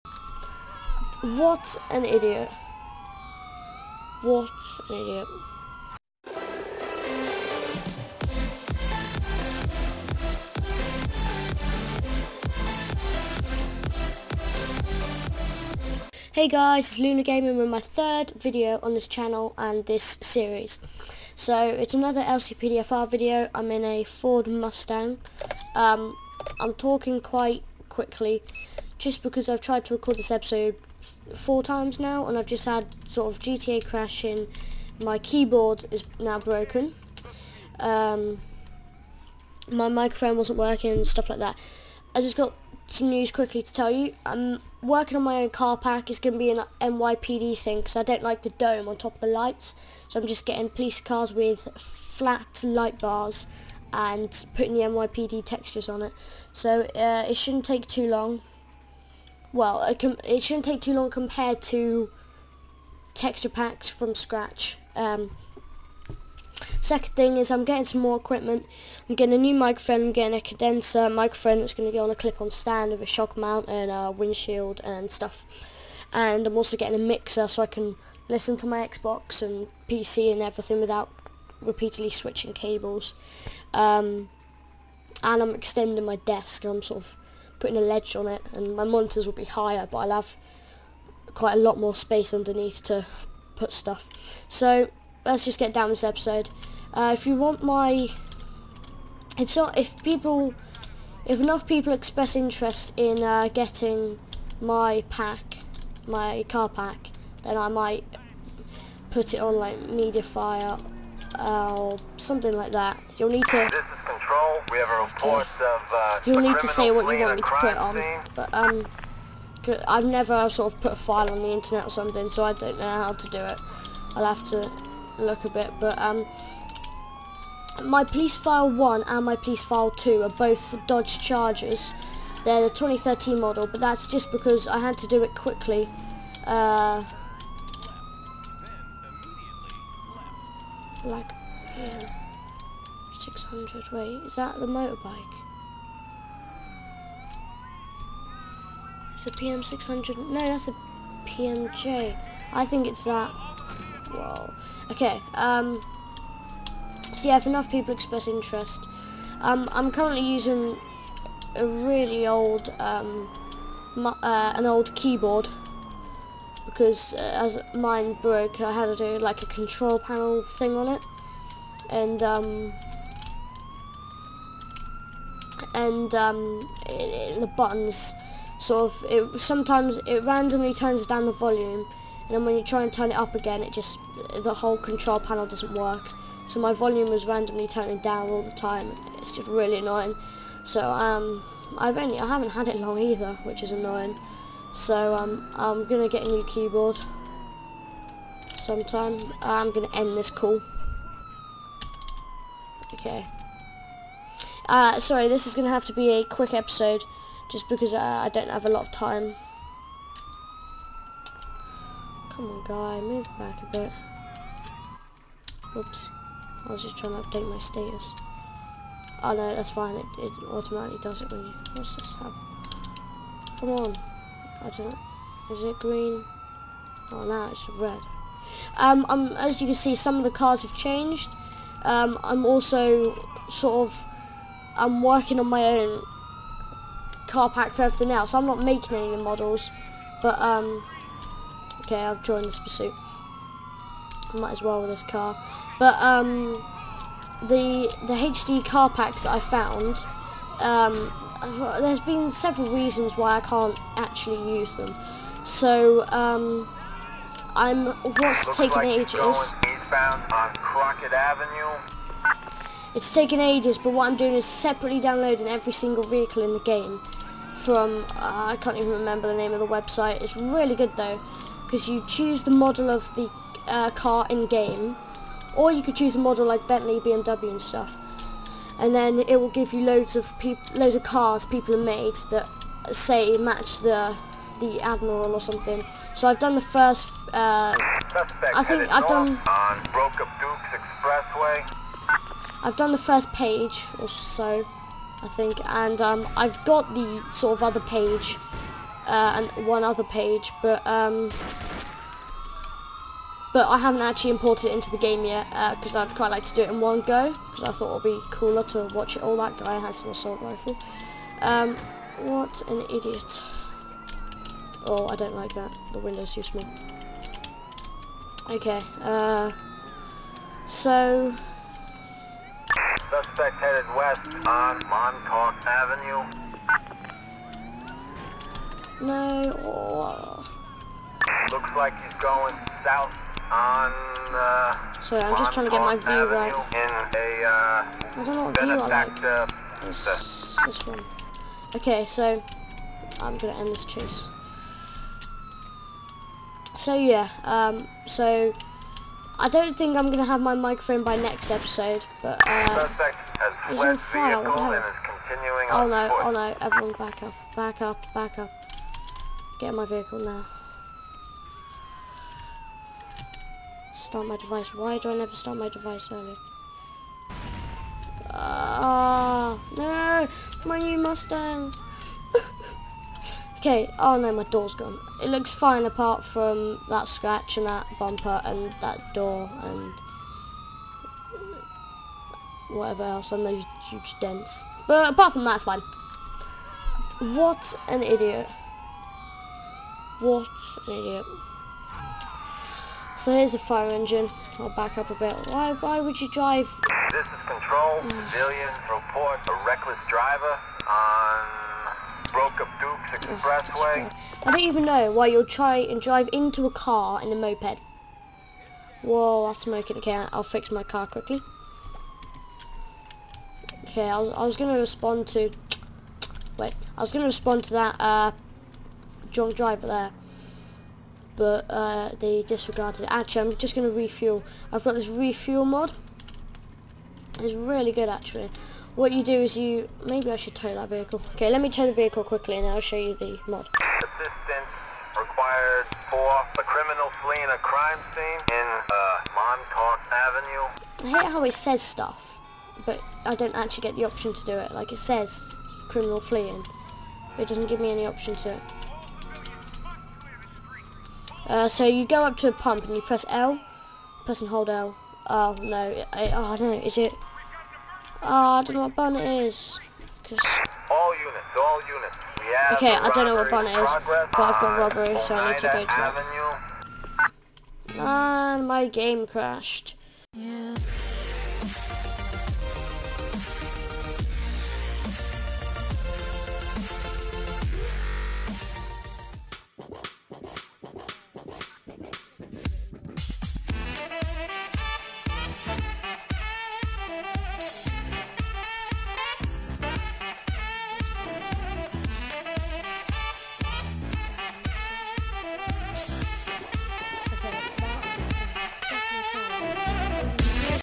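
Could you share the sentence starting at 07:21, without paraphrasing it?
I hate how it says stuff, but I don't actually get the option to do it.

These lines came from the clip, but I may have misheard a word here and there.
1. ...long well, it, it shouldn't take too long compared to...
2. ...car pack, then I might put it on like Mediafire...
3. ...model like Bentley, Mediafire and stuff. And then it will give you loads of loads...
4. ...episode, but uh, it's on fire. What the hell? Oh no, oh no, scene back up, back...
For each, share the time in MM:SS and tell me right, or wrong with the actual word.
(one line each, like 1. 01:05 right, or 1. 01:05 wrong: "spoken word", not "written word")
1. 00:58 right
2. 01:46 right
3. 04:36 wrong: "BMW", not "Mediafire"
4. 05:51 wrong: "everyone", not "scene".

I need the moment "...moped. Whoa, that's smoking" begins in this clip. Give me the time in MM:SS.
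06:47.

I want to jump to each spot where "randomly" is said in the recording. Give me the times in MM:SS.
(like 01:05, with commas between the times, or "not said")
03:00, 03:07.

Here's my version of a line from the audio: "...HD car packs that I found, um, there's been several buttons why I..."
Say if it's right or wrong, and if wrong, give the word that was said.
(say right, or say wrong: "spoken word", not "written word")
wrong: "reasons", not "buttons".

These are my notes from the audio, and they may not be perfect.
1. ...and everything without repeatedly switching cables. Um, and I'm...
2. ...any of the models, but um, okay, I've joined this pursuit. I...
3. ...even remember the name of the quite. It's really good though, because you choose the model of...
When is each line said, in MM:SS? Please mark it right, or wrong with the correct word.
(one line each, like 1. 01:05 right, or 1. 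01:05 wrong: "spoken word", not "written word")
1. 01:20 right
2. 03:58 right
3. 04:28 wrong: "website", not "quite".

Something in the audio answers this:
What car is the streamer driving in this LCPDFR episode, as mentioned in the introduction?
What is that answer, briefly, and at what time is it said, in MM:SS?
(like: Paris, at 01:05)
Ford Mustang, at 00:24.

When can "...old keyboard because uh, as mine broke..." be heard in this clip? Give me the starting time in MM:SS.
02:44.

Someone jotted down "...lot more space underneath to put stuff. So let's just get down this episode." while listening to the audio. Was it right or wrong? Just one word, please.
right.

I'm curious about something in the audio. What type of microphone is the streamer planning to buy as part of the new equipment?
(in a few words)
condenser microphone.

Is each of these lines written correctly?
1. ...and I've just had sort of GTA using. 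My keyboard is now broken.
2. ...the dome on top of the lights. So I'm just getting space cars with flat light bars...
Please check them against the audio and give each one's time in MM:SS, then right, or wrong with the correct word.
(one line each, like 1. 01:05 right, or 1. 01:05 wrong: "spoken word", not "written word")
1. 00:32 wrong: "crashing", not "using"
2. 00:48 wrong: "police", not "space".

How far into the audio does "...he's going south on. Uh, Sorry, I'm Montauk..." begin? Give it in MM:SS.
05:32.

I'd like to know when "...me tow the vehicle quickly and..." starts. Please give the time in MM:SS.
07:11.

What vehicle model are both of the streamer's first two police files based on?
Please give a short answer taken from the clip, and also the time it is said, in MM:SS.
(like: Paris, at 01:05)
Dodge Chargers, at 02:10.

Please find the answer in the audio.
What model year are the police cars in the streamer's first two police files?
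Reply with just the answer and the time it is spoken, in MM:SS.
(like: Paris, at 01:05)
2013, at 02:12.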